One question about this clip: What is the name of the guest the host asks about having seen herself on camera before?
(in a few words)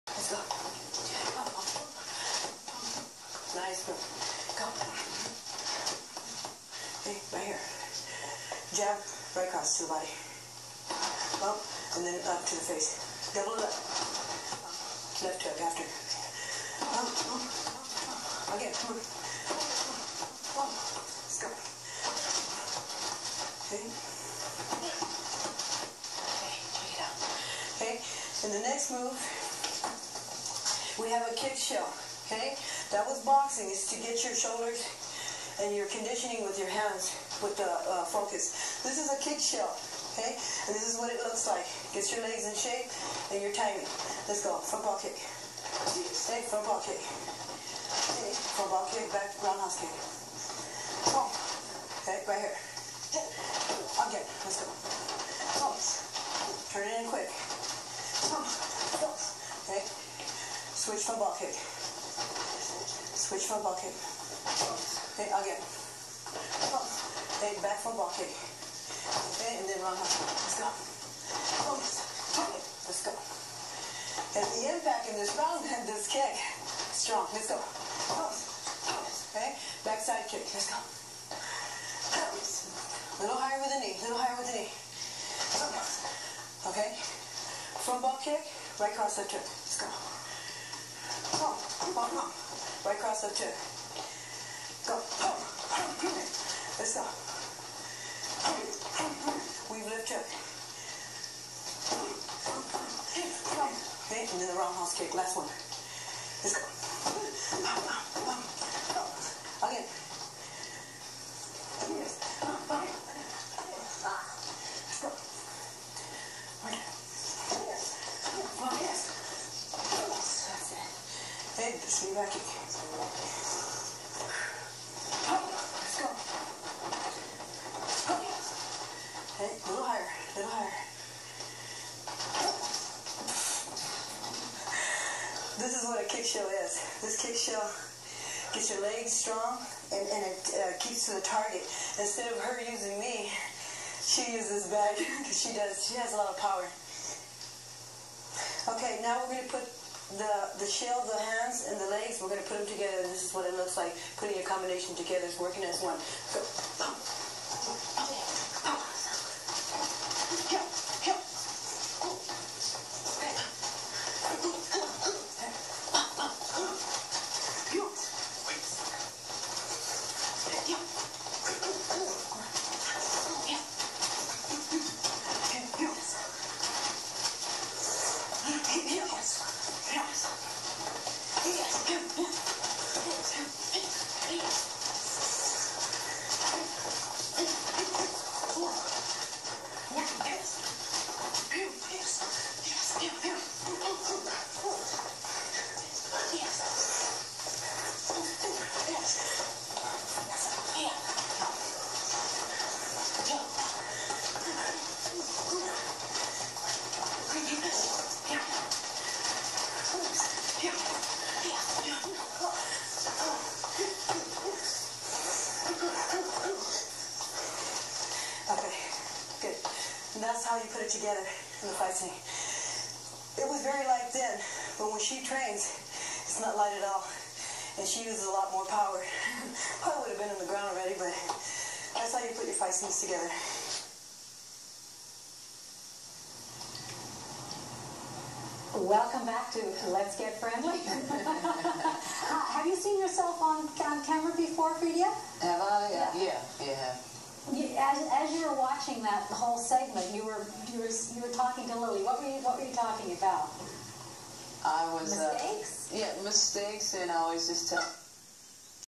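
Fredia.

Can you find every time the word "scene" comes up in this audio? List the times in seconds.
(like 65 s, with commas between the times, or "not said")
221 s, 232 s.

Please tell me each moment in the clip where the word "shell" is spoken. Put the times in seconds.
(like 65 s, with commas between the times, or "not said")
31 s, 39 s, 150 s.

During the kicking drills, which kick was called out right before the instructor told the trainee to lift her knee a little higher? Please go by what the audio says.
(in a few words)
backside kick.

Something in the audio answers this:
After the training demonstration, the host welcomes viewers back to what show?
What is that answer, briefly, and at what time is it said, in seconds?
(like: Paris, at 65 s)
Let's Get Friendly, at 239 s.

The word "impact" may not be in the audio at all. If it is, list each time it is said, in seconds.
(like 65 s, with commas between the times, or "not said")
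74 s.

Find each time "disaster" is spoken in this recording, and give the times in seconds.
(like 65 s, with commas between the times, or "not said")
not said.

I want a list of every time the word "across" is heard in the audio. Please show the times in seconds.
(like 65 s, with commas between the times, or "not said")
9 s, 92 s.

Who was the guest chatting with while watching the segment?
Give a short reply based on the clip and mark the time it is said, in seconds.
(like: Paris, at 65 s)
Lilly, at 251 s.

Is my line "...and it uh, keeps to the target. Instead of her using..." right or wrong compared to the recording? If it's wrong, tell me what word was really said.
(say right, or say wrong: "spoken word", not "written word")
right.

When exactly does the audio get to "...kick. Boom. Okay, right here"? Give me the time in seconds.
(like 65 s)
49 s.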